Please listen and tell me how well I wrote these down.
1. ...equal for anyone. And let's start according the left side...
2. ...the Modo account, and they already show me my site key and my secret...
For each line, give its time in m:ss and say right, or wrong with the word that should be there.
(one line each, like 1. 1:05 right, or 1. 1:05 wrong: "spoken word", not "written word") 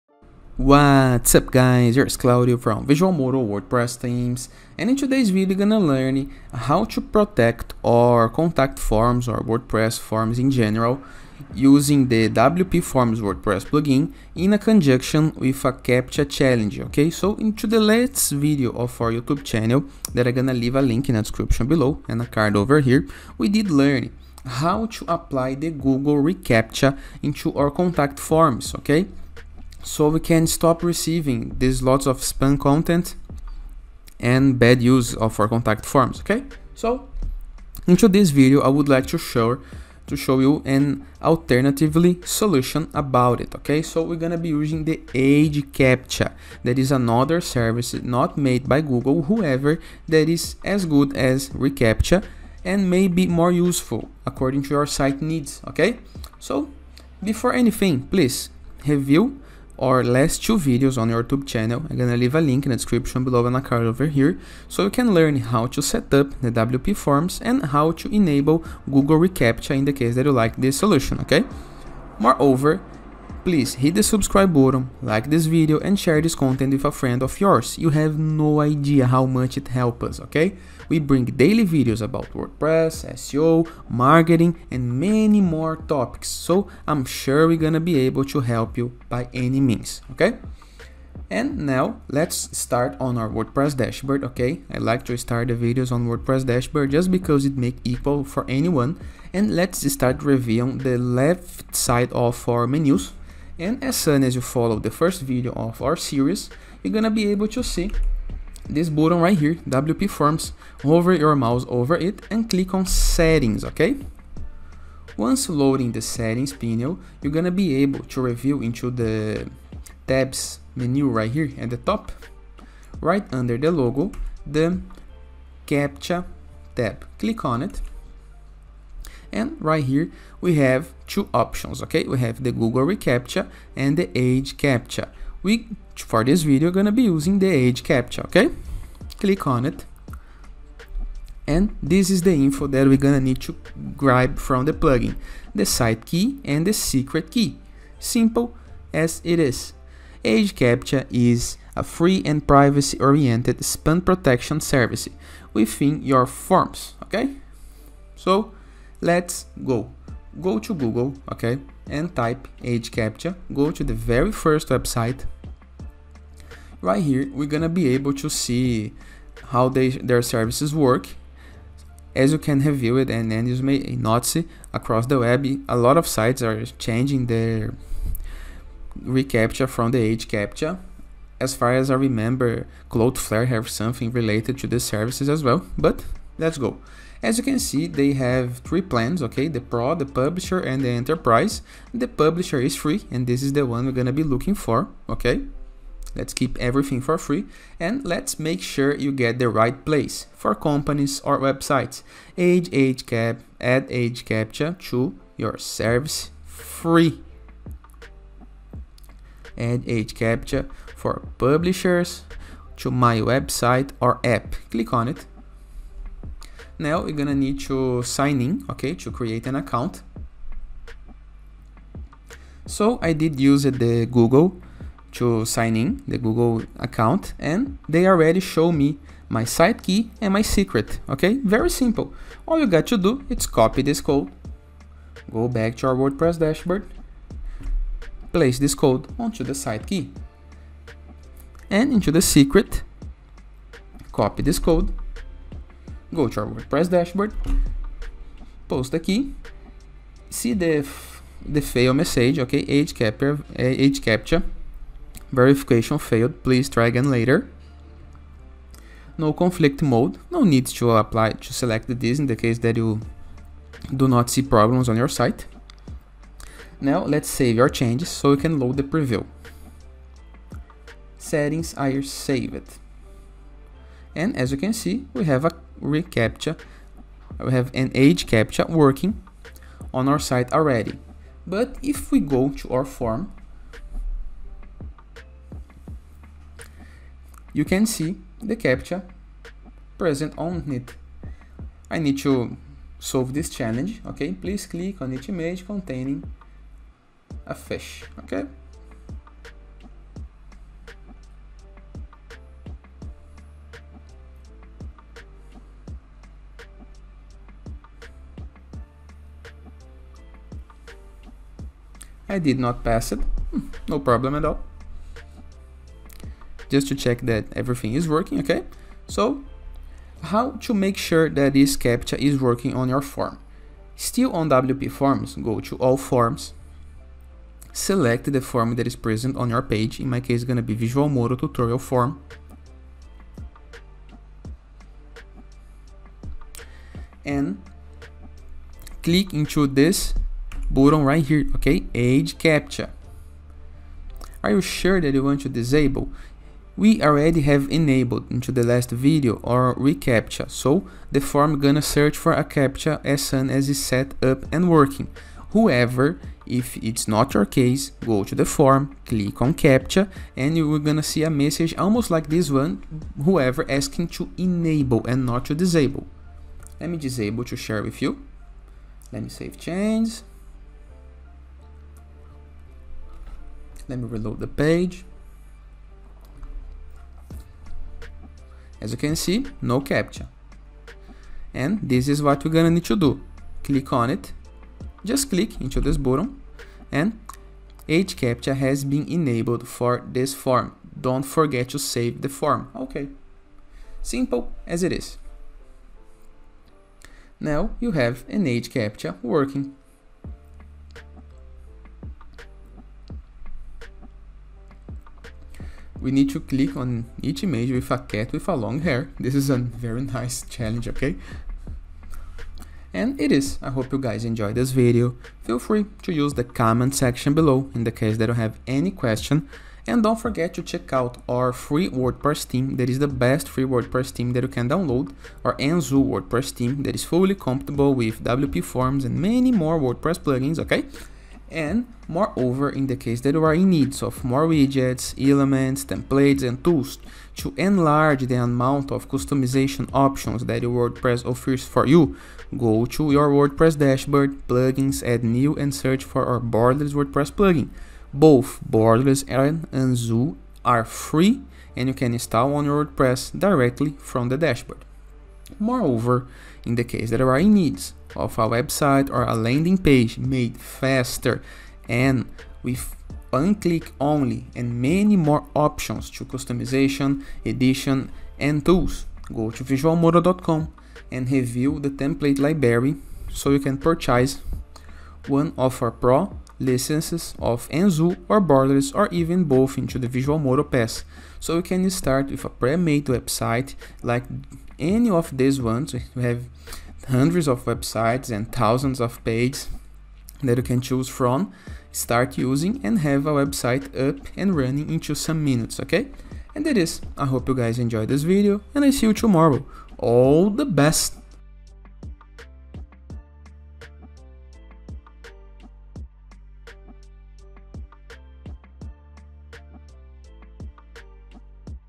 1. 1:37 wrong: "reviewing", not "according"
2. 3:46 wrong: "Google", not "Modo".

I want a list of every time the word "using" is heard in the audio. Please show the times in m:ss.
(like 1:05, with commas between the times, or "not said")
0:11, 0:44, 2:17, 8:12.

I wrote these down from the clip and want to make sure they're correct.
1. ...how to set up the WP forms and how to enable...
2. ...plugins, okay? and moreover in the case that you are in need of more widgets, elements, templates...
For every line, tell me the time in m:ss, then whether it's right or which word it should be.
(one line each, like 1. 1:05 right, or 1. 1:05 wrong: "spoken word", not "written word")
1. 1:05 right
2. 7:10 right.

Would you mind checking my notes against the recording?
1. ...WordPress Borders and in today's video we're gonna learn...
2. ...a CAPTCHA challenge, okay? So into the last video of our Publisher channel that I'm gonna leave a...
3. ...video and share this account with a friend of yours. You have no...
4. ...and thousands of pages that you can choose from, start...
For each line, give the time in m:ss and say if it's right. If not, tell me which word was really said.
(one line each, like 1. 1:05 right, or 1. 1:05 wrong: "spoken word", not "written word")
1. 0:03 wrong: "Themes", not "Borders"
2. 0:15 wrong: "YouTube", not "Publisher"
3. 1:15 wrong: "content", not "account"
4. 8:08 right.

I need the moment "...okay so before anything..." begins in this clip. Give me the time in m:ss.
0:55.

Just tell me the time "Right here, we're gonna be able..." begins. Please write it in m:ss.
2:46.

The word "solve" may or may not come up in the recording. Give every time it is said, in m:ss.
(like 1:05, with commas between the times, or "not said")
4:52.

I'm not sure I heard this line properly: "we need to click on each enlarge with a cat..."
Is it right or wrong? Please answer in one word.
wrong.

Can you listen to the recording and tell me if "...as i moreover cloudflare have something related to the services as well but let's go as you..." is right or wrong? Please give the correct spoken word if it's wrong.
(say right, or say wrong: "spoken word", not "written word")
wrong: "remember", not "moreover".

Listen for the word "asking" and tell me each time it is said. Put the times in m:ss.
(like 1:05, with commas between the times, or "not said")
6:03.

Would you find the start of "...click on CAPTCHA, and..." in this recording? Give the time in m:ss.
5:59.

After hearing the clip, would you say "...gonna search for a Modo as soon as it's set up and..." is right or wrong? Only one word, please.
wrong.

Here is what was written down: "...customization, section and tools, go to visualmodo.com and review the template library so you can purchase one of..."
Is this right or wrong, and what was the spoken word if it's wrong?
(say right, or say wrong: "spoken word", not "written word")
wrong: "edition", not "section".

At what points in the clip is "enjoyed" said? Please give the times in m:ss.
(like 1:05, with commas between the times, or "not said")
6:54, 8:17.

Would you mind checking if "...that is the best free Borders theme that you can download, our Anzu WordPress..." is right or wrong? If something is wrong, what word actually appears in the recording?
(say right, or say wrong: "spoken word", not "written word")
wrong: "WordPress", not "Borders".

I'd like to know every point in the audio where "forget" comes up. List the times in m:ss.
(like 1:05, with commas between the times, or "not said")
6:31, 7:00.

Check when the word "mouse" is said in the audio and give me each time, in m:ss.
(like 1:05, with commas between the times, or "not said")
1:51.